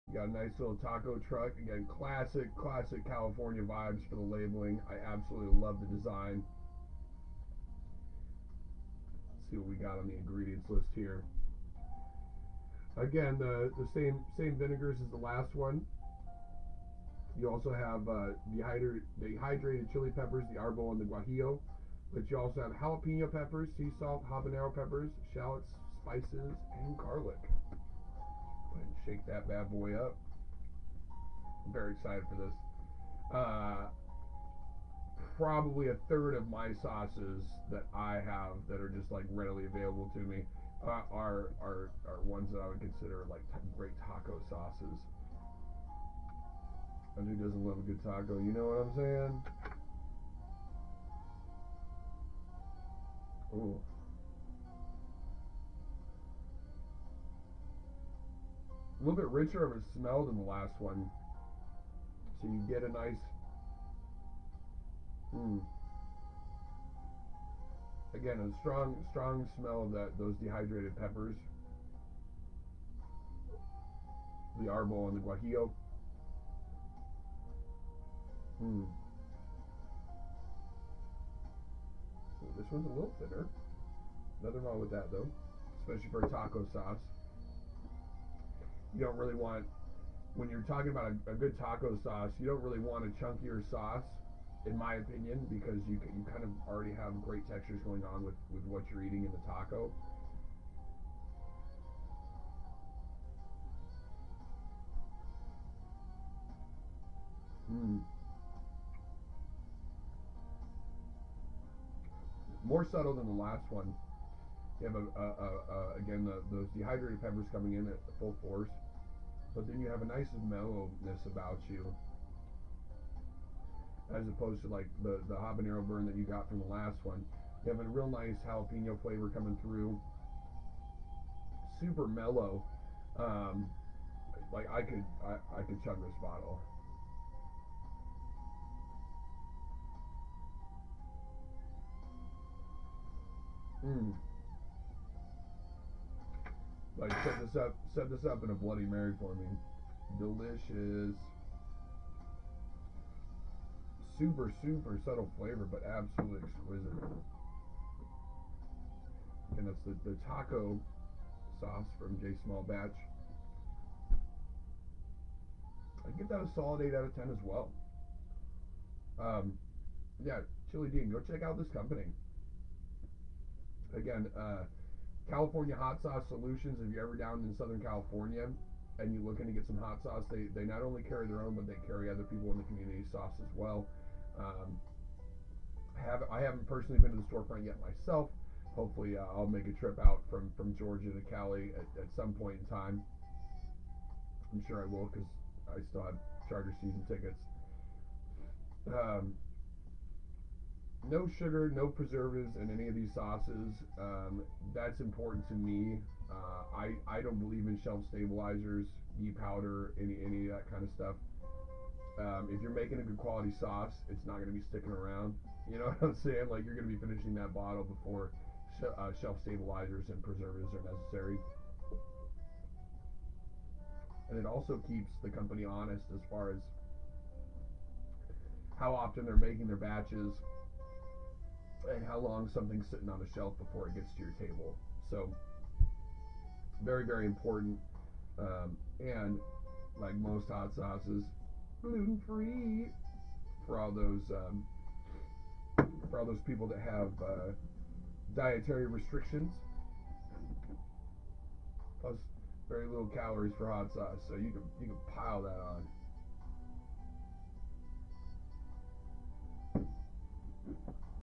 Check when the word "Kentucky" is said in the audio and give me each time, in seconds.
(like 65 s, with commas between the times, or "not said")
not said.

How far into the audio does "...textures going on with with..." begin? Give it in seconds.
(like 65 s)
97 s.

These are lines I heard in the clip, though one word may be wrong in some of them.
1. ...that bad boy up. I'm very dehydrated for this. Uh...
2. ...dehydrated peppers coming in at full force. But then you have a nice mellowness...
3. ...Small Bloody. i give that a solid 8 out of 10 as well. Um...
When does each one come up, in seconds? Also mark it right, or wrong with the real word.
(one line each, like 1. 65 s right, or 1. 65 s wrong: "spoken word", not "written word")
1. 29 s wrong: "excited", not "dehydrated"
2. 116 s right
3. 162 s wrong: "Batch", not "Bloody".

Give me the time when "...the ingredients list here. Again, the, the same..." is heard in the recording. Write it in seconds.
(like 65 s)
10 s.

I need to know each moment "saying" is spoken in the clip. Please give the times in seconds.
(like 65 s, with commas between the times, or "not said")
48 s, 216 s.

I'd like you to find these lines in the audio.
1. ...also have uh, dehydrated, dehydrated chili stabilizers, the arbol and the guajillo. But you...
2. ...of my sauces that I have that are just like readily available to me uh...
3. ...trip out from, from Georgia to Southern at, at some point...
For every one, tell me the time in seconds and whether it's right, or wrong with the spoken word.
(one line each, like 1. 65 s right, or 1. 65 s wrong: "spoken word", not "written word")
1. 17 s wrong: "peppers", not "stabilizers"
2. 36 s right
3. 189 s wrong: "Cali", not "Southern".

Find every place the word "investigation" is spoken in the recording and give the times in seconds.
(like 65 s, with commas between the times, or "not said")
not said.